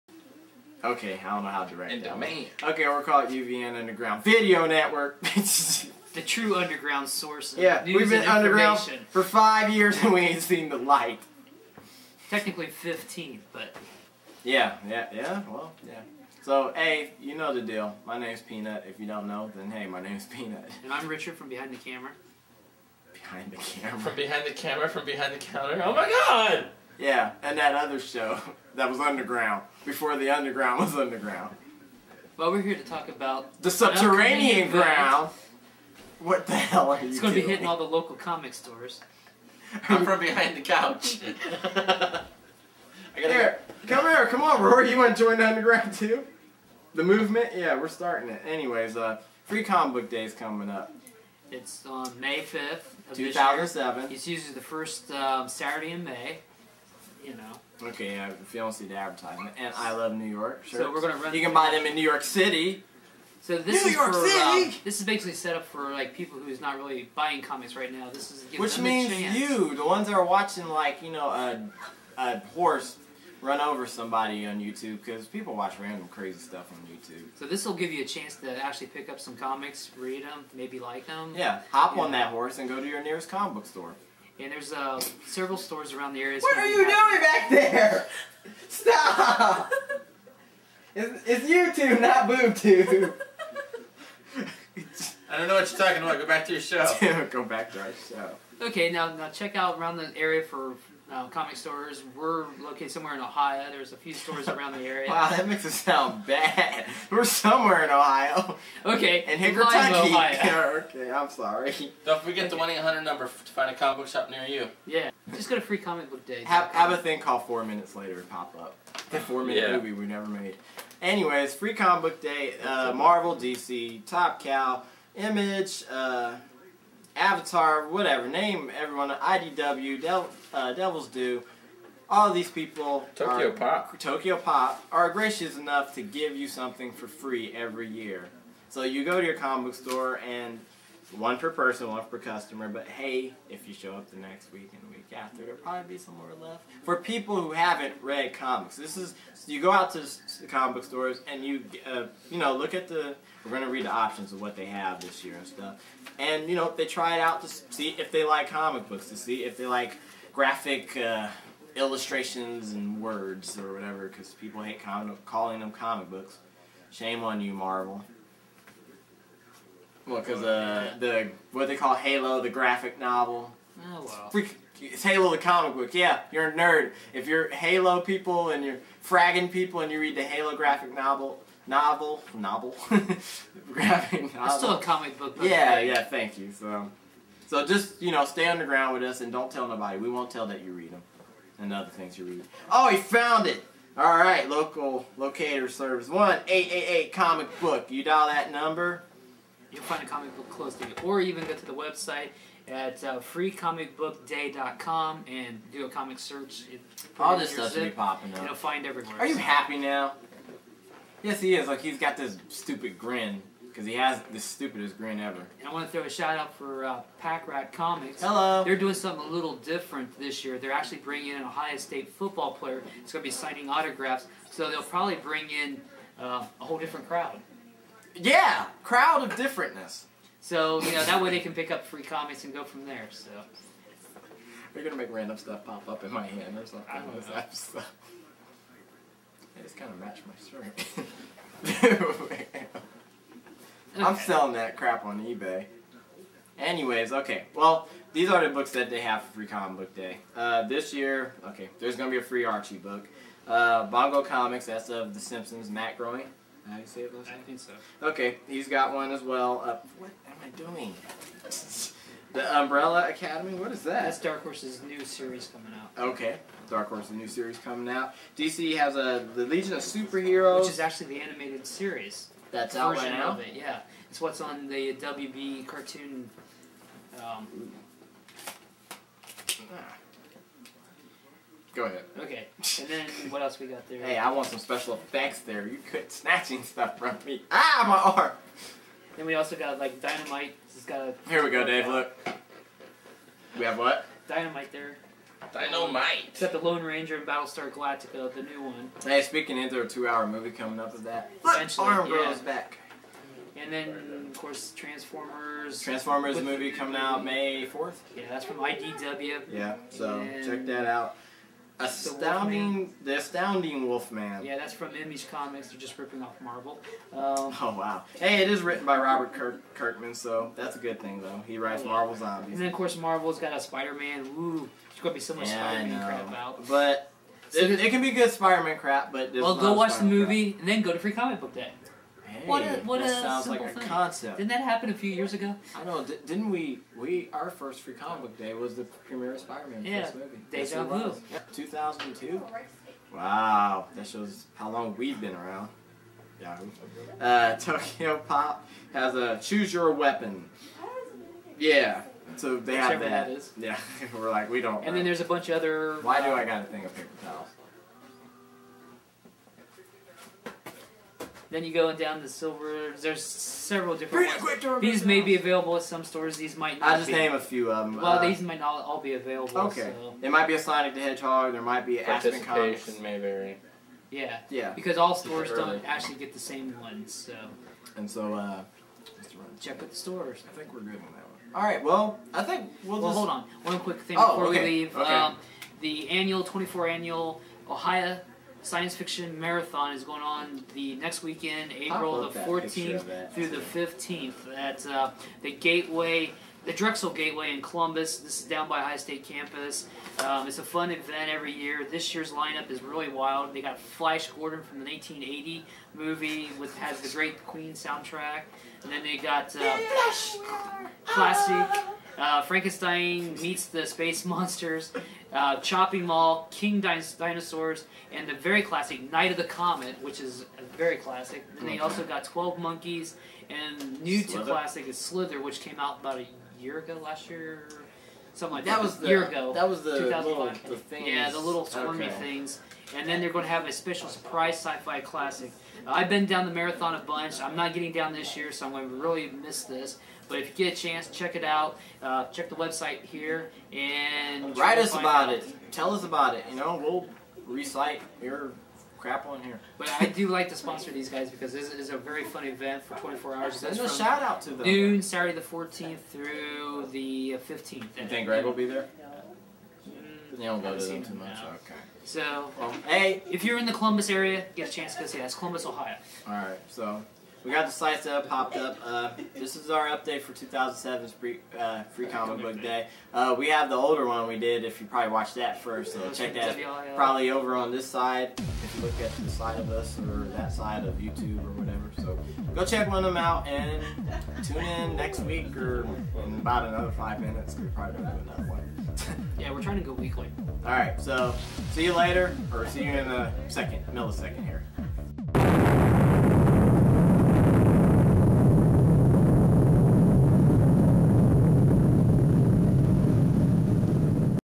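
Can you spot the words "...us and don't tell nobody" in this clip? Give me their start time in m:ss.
3:09.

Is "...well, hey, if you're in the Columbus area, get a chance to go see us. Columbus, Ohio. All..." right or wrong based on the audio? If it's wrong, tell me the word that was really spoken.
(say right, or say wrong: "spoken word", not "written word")
right.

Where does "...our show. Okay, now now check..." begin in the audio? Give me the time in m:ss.
1:37.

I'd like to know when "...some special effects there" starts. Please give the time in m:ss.
4:44.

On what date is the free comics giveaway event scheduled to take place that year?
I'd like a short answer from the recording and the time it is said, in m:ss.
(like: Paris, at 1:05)
May 5th, at 0:52.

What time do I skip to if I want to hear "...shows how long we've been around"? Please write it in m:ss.
5:44.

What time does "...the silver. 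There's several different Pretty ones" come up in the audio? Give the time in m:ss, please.
6:02.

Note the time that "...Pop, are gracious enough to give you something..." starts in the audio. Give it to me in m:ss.
2:14.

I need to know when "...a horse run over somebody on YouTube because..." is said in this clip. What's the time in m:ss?
1:12.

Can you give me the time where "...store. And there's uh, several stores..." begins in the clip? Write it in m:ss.
1:23.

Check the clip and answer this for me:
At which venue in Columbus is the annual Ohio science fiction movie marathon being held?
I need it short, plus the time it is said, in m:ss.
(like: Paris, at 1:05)
the Drexel Gateway, at 6:36.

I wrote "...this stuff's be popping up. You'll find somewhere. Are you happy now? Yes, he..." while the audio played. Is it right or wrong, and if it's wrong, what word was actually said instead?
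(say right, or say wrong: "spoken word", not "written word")
wrong: "everywhere", not "somewhere".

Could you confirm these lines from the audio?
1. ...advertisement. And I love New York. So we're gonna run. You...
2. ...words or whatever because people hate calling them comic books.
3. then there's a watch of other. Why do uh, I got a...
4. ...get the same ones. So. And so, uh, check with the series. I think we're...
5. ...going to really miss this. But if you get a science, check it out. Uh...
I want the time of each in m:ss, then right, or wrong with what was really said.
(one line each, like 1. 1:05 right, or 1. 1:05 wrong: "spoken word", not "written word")
1. 0:58 right
2. 2:43 right
3. 5:54 wrong: "bunch", not "watch"
4. 6:16 wrong: "stores", not "series"
5. 7:18 wrong: "chance", not "science".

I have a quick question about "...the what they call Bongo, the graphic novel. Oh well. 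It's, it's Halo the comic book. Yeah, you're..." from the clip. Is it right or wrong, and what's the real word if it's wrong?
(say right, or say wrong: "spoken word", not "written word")
wrong: "Halo", not "Bongo".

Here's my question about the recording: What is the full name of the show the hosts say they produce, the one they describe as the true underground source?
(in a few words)
Underground Video Network.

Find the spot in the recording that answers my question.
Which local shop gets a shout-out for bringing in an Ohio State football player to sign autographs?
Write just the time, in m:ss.
3:37.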